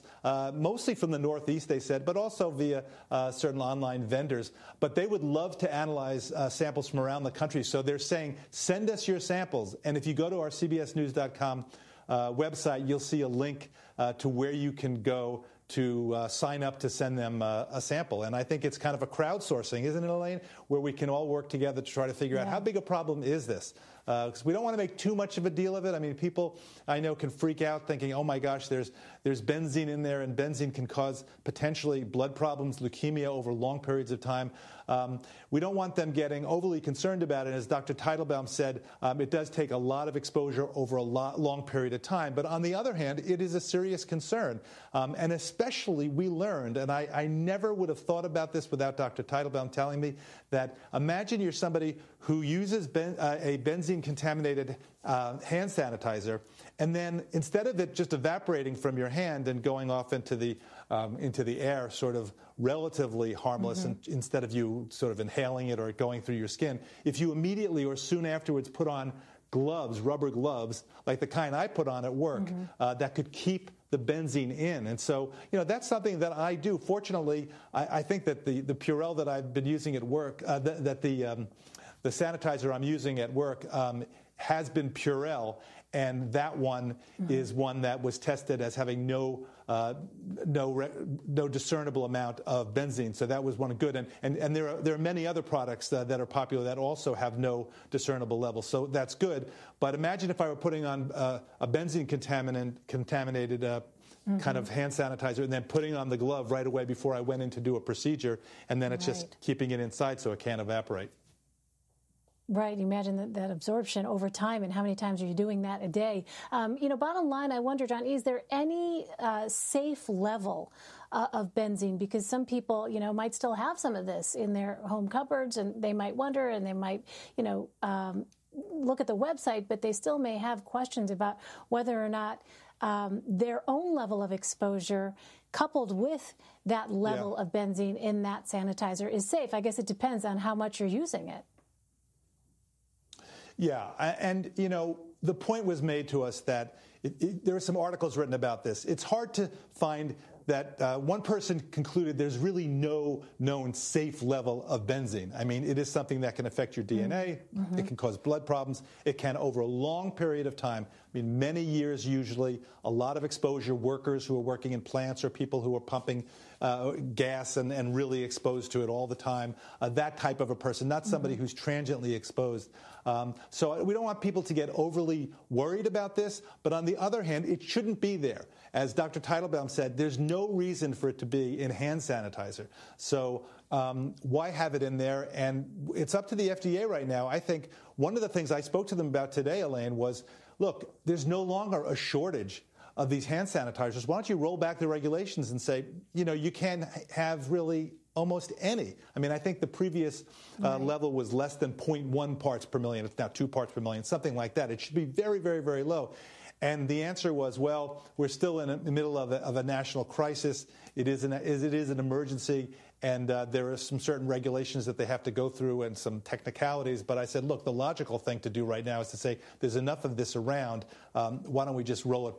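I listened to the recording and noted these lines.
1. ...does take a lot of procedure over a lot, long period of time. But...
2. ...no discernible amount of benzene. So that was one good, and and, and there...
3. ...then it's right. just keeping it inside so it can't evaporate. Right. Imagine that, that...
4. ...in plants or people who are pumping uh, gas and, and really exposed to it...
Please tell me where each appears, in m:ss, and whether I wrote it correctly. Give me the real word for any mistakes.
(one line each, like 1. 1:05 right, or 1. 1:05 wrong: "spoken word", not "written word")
1. 0:39 wrong: "exposure", not "procedure"
2. 1:31 right
3. 1:48 right
4. 2:44 right.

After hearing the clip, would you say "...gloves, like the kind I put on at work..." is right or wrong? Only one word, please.
right.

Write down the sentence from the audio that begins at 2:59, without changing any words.
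Teitelbaum said, there's no reason for it to be in hand sanitizer.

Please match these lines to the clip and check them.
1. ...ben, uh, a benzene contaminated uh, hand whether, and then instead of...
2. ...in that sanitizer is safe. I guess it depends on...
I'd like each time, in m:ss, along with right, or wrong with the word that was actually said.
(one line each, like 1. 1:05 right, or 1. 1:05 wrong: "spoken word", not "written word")
1. 0:52 wrong: "sanitizer", not "whether"
2. 2:17 right.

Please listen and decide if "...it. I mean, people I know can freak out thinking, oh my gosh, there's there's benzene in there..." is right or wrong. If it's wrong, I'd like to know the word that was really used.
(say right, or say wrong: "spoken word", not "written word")
right.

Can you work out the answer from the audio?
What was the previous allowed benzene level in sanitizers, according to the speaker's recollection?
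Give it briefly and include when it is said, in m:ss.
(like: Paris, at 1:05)
less than 0.1 parts per million, at 3:21.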